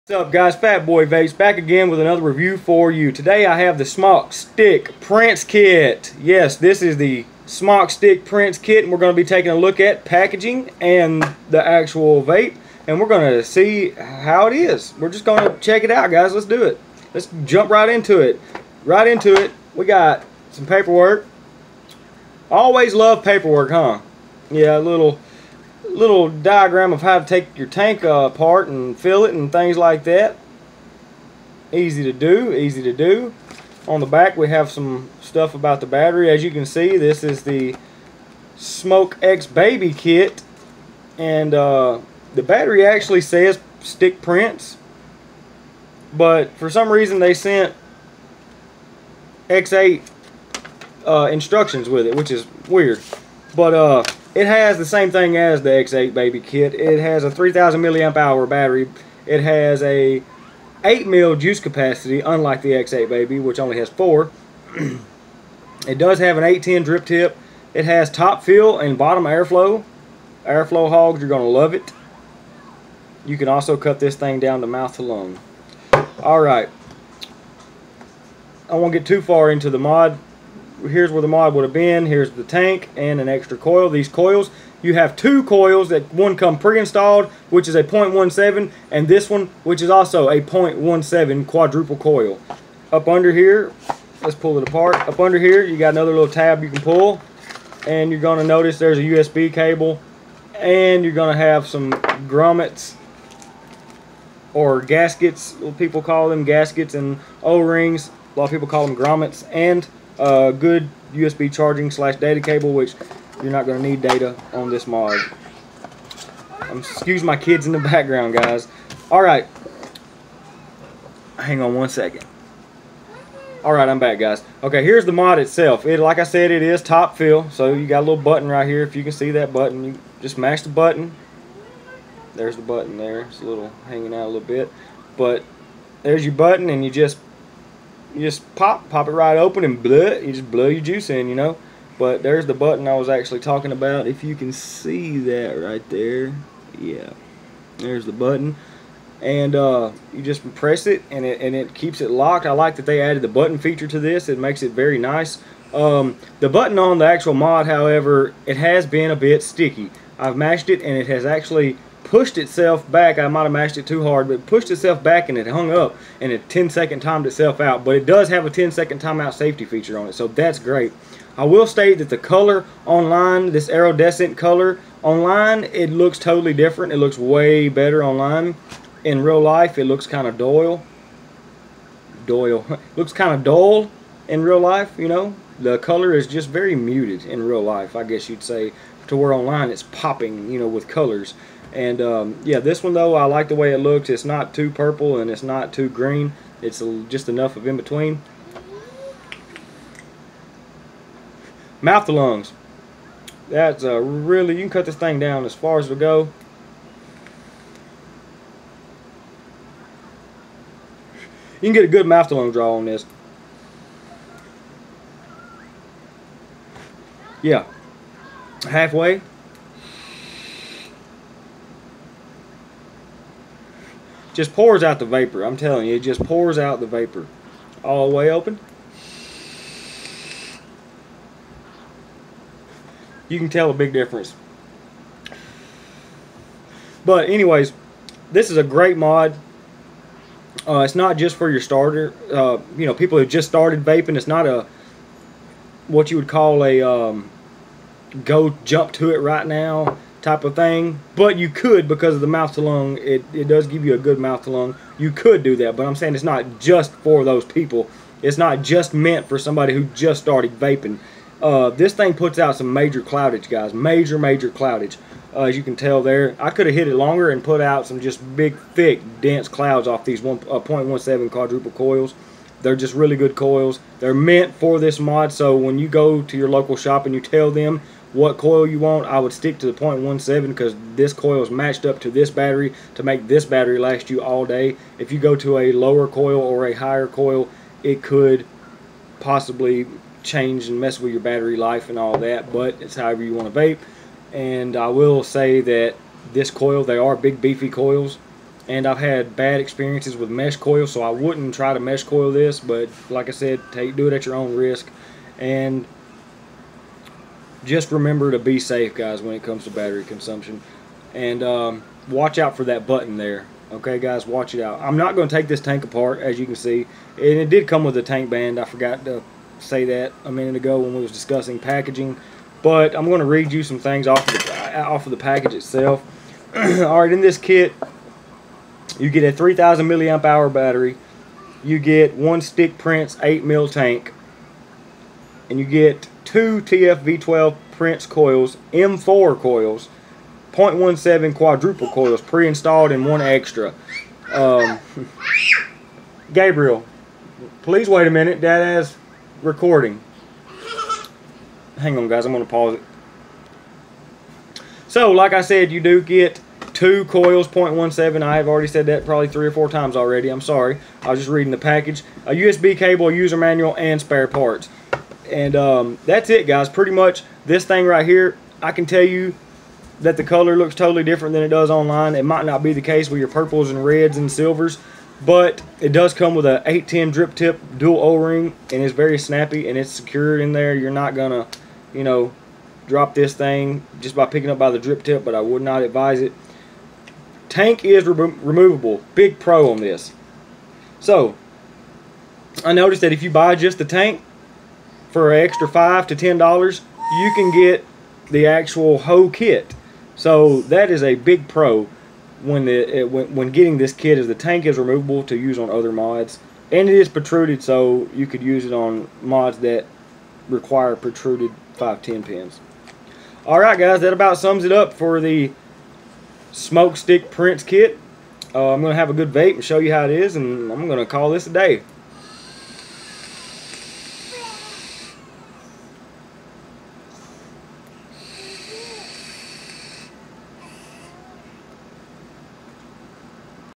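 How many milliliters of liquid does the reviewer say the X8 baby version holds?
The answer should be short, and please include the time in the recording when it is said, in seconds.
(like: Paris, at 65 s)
4, at 63 s.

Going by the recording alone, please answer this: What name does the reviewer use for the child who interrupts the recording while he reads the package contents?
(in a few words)
Gabriel.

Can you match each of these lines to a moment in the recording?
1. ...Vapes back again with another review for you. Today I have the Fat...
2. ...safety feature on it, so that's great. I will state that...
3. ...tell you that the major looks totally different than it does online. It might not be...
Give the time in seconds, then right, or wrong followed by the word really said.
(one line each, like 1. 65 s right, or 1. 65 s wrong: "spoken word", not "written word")
1. 1 s wrong: "Smok", not "Fat"
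2. 169 s right
3. 368 s wrong: "color", not "major".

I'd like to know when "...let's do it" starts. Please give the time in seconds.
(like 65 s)
16 s.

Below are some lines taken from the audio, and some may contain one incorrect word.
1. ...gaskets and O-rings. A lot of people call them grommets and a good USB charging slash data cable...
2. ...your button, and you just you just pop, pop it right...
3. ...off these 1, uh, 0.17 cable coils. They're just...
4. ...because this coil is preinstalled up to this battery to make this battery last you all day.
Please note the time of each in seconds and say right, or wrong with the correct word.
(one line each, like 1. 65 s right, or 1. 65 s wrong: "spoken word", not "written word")
1. 106 s right
2. 136 s right
3. 269 s wrong: "quadruple", not "cable"
4. 280 s wrong: "matched", not "preinstalled".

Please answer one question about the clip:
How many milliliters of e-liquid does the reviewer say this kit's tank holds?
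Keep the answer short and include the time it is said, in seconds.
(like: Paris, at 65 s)
8 ml, at 60 s.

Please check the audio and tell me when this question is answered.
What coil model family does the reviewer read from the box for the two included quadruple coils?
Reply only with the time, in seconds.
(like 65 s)
336 s.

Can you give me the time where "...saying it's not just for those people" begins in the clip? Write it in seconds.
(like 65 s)
255 s.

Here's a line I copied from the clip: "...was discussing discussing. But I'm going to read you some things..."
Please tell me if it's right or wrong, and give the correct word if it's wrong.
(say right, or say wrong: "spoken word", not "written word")
wrong: "packaging", not "discussing".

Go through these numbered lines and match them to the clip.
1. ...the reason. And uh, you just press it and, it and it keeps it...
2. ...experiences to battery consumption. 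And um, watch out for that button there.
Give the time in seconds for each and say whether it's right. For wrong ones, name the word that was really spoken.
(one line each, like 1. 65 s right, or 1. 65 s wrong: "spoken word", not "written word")
1. 148 s wrong: "button", not "reason"
2. 309 s wrong: "comes", not "experiences".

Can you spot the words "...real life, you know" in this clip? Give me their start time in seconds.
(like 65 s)
184 s.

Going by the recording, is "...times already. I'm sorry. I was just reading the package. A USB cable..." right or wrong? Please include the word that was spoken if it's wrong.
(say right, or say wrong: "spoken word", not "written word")
right.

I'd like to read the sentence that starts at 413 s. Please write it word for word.
All right, guys, that about sums it up for the Smok Stick Prince kit.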